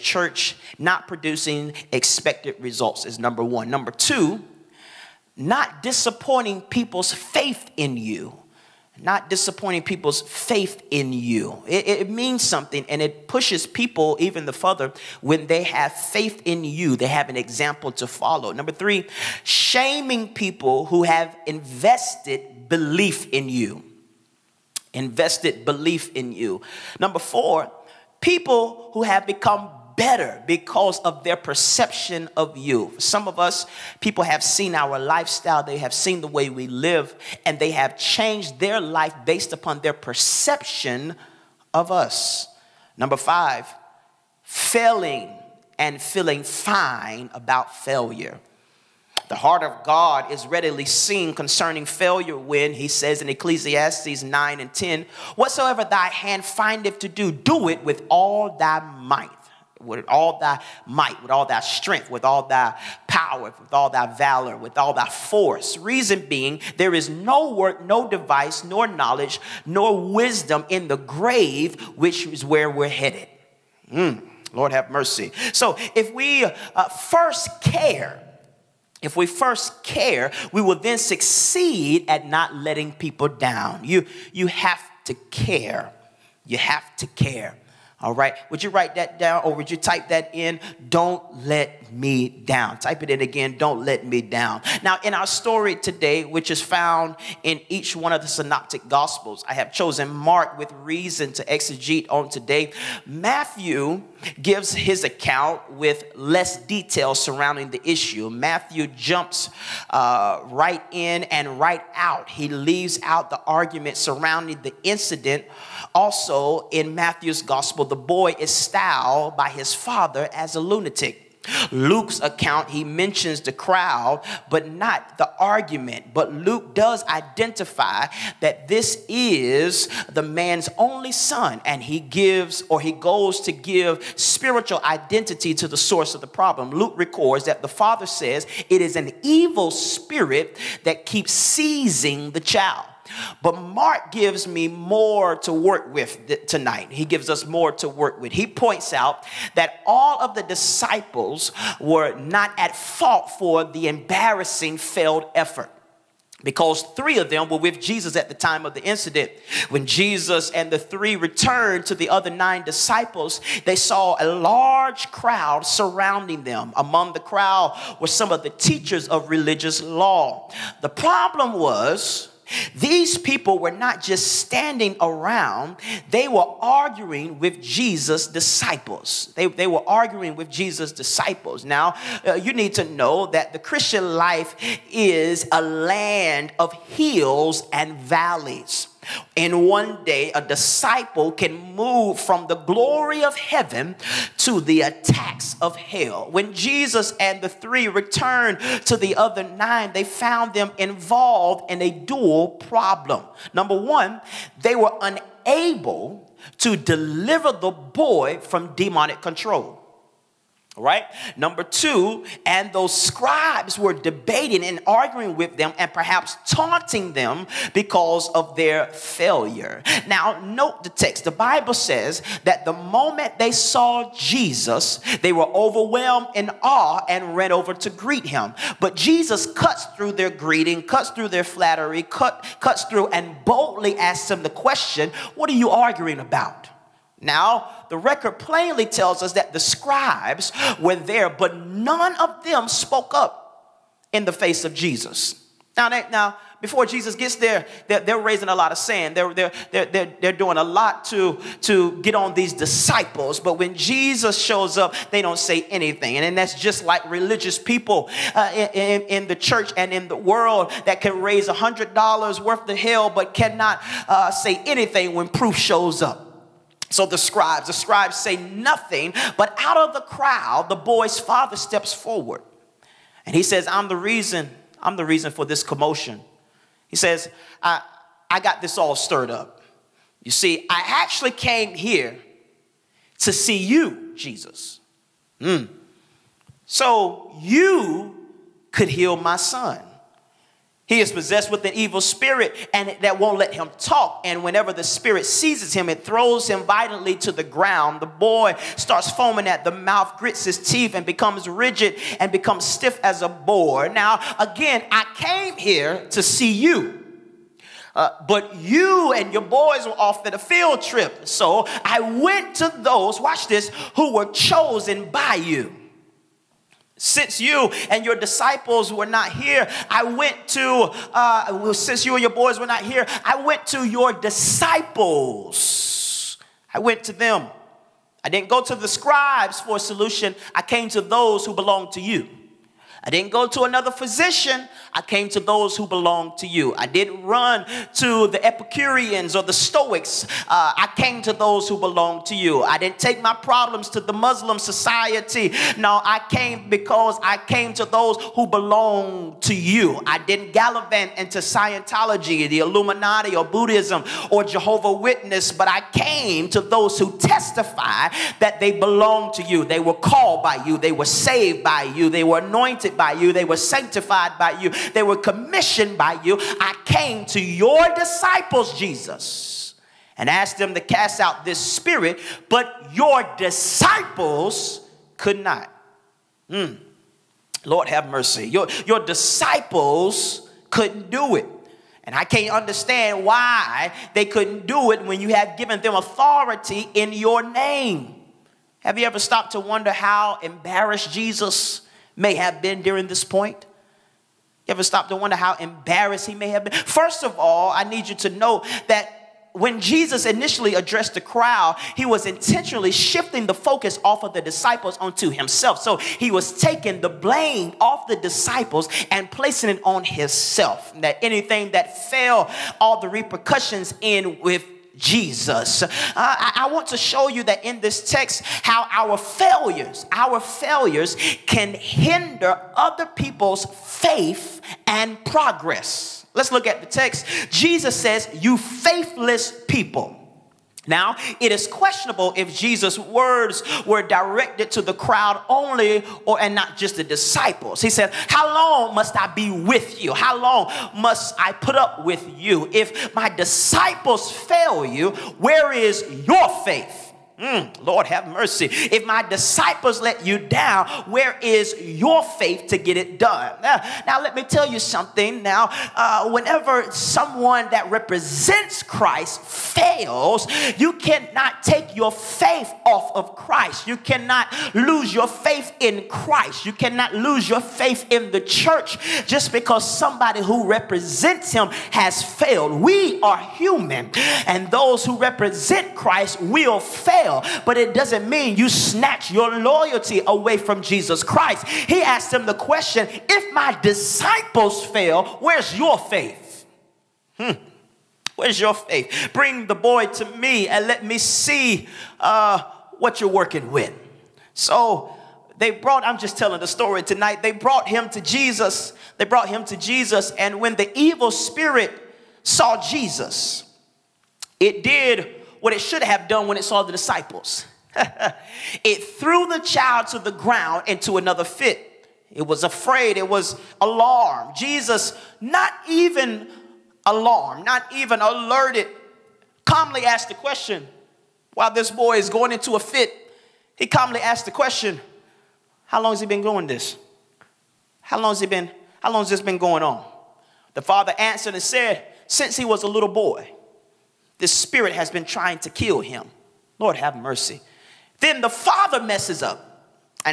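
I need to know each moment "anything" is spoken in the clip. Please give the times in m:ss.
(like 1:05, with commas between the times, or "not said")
4:15, 4:24, 6:51.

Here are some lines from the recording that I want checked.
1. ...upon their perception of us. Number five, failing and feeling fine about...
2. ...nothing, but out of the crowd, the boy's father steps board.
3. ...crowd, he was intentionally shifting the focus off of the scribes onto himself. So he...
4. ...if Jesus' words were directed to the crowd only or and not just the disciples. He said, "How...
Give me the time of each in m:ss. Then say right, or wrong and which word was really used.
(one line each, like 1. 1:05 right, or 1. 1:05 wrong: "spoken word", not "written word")
1. 0:39 right
2. 4:28 wrong: "forward", not "board"
3. 6:41 wrong: "disciples", not "scribes"
4. 7:12 right.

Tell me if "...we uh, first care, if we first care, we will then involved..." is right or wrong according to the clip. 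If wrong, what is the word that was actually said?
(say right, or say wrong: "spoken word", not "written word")
wrong: "succeed", not "involved".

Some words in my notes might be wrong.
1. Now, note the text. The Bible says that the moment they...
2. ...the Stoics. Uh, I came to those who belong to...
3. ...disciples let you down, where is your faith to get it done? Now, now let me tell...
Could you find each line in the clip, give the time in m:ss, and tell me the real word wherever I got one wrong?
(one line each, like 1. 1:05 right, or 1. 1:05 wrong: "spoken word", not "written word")
1. 3:40 right
2. 5:39 right
3. 7:29 right.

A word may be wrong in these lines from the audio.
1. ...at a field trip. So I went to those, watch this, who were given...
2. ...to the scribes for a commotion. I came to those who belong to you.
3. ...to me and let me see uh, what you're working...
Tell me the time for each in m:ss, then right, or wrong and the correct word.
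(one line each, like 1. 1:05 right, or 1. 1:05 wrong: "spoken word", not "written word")
1. 5:10 wrong: "chosen", not "given"
2. 5:28 wrong: "solution", not "commotion"
3. 8:10 right.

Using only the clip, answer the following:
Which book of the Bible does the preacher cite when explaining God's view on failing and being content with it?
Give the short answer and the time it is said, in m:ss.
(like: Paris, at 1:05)
Ecclesiastes, at 0:53.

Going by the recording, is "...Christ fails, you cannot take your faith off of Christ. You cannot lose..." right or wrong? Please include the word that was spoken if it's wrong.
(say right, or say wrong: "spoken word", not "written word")
right.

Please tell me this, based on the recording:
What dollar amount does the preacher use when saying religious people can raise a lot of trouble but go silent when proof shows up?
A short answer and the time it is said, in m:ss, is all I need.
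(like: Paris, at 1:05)
$100, at 4:21.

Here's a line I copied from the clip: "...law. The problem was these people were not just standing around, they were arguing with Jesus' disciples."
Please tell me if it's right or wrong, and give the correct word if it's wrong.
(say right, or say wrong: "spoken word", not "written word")
right.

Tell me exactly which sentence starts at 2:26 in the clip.
He gives us more to work with.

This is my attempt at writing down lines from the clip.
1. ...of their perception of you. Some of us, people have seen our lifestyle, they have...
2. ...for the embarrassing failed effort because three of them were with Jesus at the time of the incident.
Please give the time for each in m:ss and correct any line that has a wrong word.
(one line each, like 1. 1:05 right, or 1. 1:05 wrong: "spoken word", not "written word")
1. 0:30 right
2. 2:33 right.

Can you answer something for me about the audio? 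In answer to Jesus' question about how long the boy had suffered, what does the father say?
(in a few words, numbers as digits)
Since he was a little boy.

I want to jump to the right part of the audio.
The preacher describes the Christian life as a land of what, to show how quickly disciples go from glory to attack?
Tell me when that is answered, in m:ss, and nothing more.
3:06.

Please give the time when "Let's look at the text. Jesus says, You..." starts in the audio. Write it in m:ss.
7:06.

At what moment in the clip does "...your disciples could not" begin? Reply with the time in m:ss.
6:12.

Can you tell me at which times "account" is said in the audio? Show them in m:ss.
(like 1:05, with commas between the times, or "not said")
1:45, 2:02.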